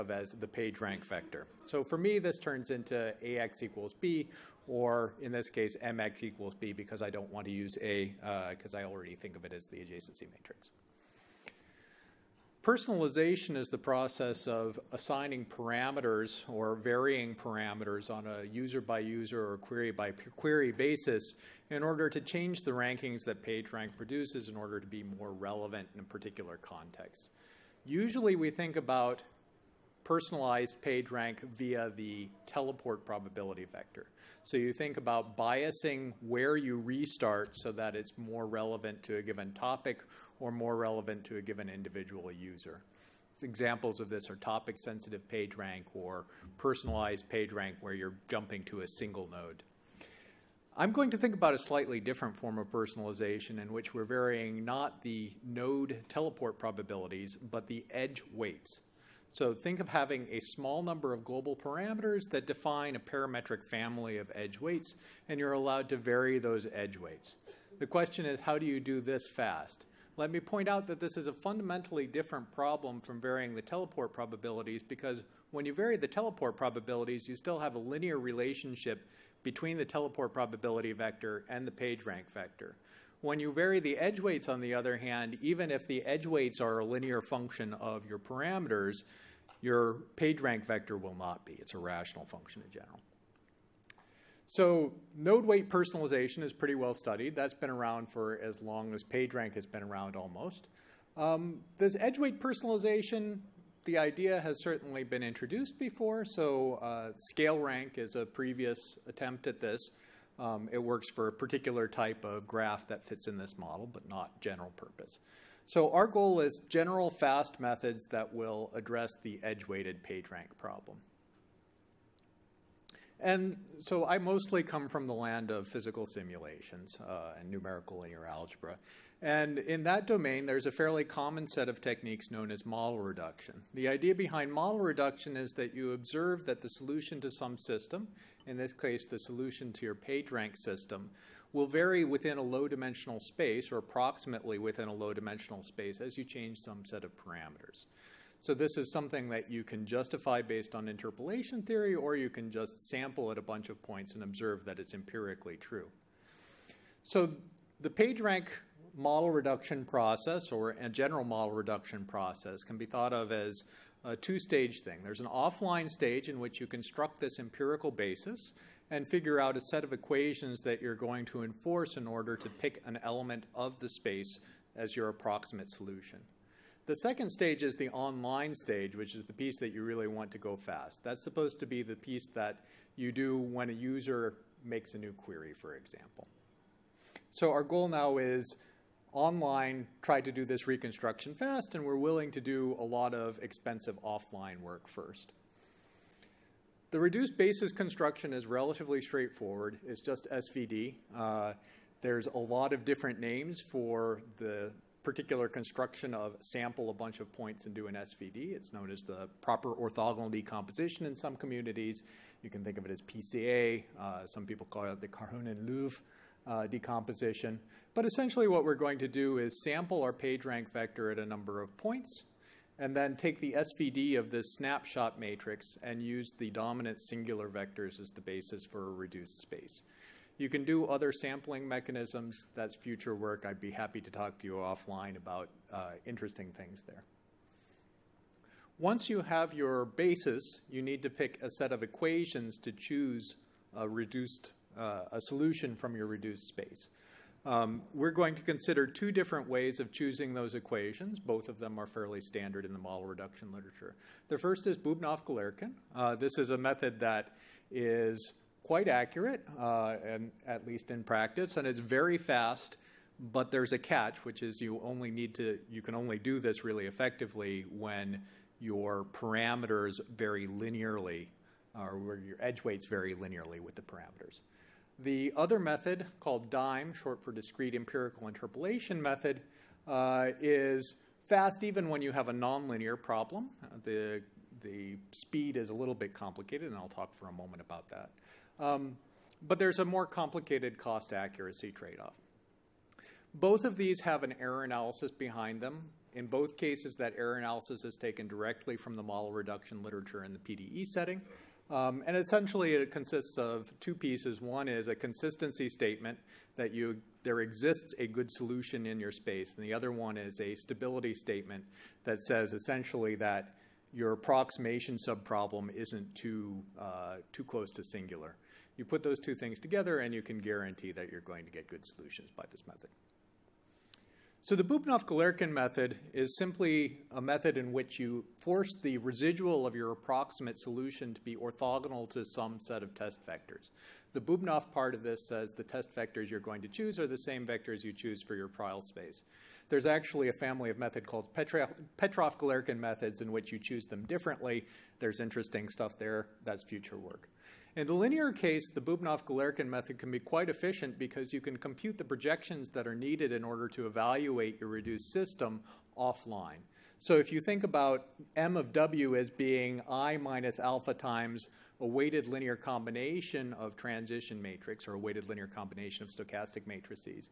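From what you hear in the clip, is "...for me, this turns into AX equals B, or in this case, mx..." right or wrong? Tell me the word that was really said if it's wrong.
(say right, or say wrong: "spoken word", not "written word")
right.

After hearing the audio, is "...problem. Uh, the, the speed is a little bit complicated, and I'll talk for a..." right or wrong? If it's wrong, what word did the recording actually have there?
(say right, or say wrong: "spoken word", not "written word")
right.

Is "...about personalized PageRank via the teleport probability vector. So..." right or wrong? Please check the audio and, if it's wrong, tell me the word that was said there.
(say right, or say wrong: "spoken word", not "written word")
right.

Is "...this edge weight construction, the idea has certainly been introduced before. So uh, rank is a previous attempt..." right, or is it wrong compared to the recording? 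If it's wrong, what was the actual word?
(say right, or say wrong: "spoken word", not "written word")
wrong: "personalization", not "construction".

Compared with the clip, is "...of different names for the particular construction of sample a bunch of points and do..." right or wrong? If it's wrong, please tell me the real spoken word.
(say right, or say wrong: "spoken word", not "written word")
right.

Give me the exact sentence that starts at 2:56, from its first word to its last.
The second stage is the online stage, which is the piece that you really want to go fast.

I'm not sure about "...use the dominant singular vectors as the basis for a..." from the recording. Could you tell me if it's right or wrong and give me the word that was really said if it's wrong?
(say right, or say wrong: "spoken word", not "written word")
right.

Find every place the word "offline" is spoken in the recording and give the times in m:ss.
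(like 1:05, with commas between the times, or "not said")
2:45, 3:14, 3:54, 5:55.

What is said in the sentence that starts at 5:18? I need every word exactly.
You put those two things together, and you can guarantee that you're going to get good solutions by this method.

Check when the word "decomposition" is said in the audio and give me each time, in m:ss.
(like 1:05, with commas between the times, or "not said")
3:30, 3:36.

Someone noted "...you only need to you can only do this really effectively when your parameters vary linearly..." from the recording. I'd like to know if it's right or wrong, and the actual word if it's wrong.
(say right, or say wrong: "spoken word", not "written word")
right.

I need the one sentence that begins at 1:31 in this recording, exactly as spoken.
It's a rational function in general.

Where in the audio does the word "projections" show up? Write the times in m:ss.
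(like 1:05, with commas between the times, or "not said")
5:52.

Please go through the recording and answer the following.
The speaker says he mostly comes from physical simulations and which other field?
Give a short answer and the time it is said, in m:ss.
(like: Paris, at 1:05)
numerical linear algebra, at 2:07.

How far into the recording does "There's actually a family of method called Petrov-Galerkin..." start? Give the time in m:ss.
5:39.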